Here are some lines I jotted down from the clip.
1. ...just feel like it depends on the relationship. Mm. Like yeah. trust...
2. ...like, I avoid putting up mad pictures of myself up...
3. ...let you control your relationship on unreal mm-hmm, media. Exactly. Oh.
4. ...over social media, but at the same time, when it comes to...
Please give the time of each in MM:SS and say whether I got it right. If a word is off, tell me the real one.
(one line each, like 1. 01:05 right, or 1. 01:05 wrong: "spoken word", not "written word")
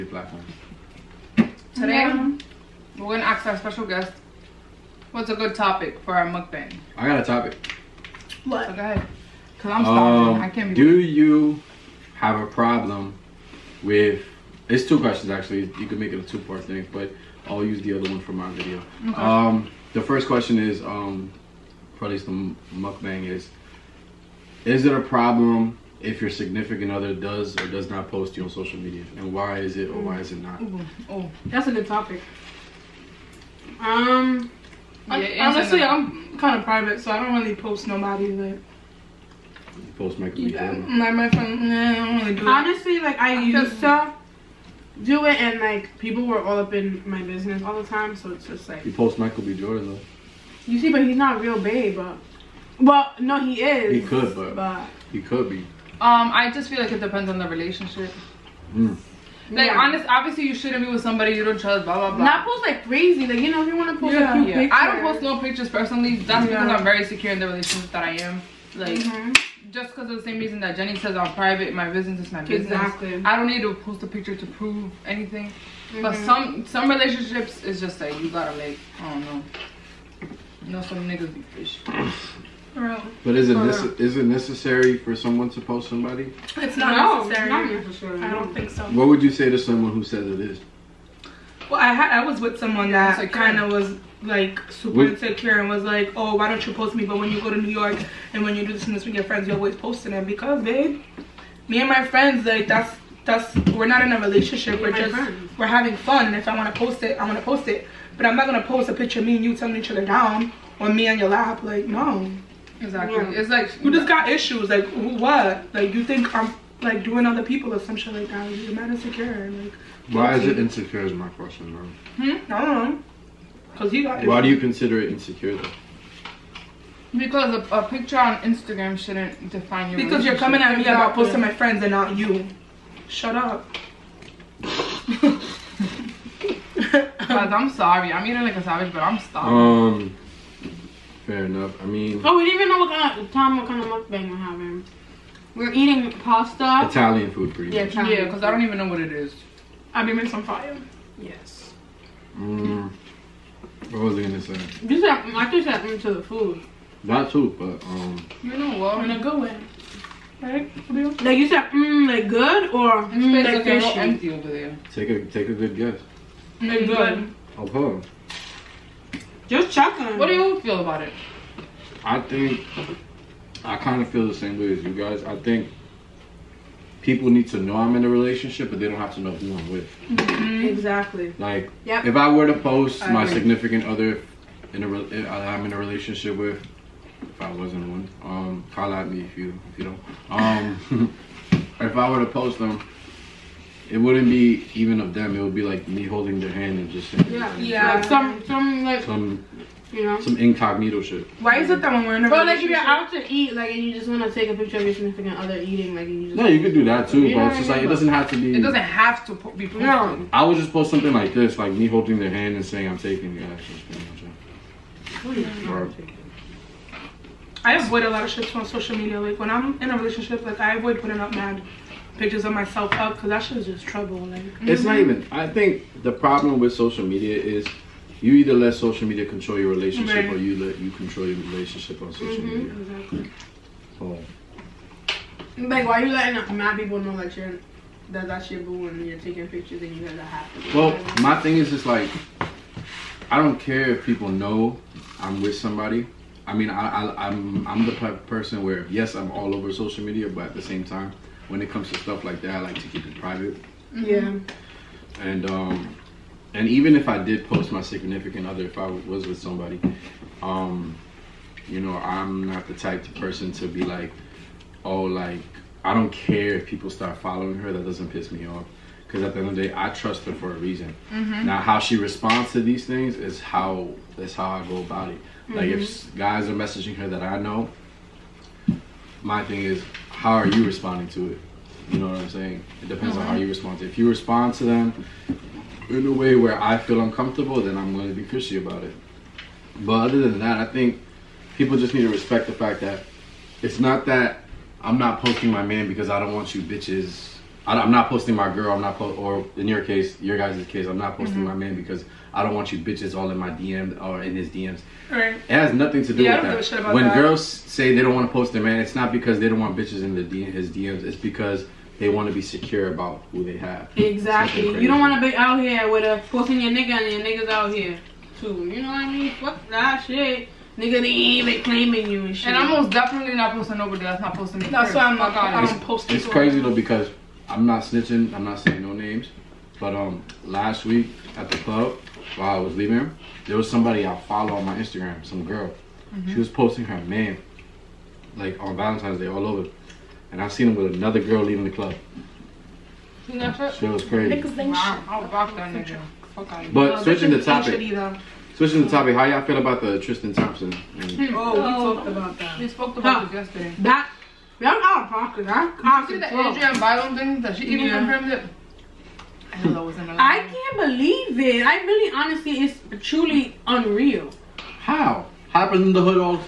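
1. 00:56 wrong: "honest", not "trust"
2. 03:40 right
3. 03:50 wrong: "social", not "unreal"
4. 04:09 right.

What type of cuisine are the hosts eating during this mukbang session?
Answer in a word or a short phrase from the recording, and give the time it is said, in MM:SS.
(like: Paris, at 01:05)
Italian food, at 02:26.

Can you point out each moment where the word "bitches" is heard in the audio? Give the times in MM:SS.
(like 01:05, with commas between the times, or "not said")
04:56, 05:02, 05:09.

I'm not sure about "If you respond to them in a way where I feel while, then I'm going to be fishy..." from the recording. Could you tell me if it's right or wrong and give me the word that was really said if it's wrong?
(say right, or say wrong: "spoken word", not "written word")
wrong: "uncomfortable", not "while".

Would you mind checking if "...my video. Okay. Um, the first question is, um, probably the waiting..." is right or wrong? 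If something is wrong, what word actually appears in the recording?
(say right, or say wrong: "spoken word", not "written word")
wrong: "mukbang", not "waiting".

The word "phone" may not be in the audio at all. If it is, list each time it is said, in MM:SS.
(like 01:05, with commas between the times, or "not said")
not said.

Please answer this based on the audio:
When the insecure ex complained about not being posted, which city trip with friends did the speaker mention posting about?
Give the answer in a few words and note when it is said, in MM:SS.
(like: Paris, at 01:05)
New York, at 01:37.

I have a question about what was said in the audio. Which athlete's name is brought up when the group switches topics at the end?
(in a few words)
Tristan Thompson.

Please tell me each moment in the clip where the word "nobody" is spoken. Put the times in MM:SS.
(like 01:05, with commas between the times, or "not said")
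00:37, 05:23.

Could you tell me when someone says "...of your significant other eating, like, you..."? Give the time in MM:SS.
03:24.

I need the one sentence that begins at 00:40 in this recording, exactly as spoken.
Yeah, my, my friend, nah, I don't really do Honestly, it.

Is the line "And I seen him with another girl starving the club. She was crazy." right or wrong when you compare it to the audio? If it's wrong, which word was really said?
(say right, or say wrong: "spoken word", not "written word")
wrong: "leaving", not "starving".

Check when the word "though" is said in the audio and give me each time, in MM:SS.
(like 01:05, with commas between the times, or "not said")
00:49, 02:05, 05:26.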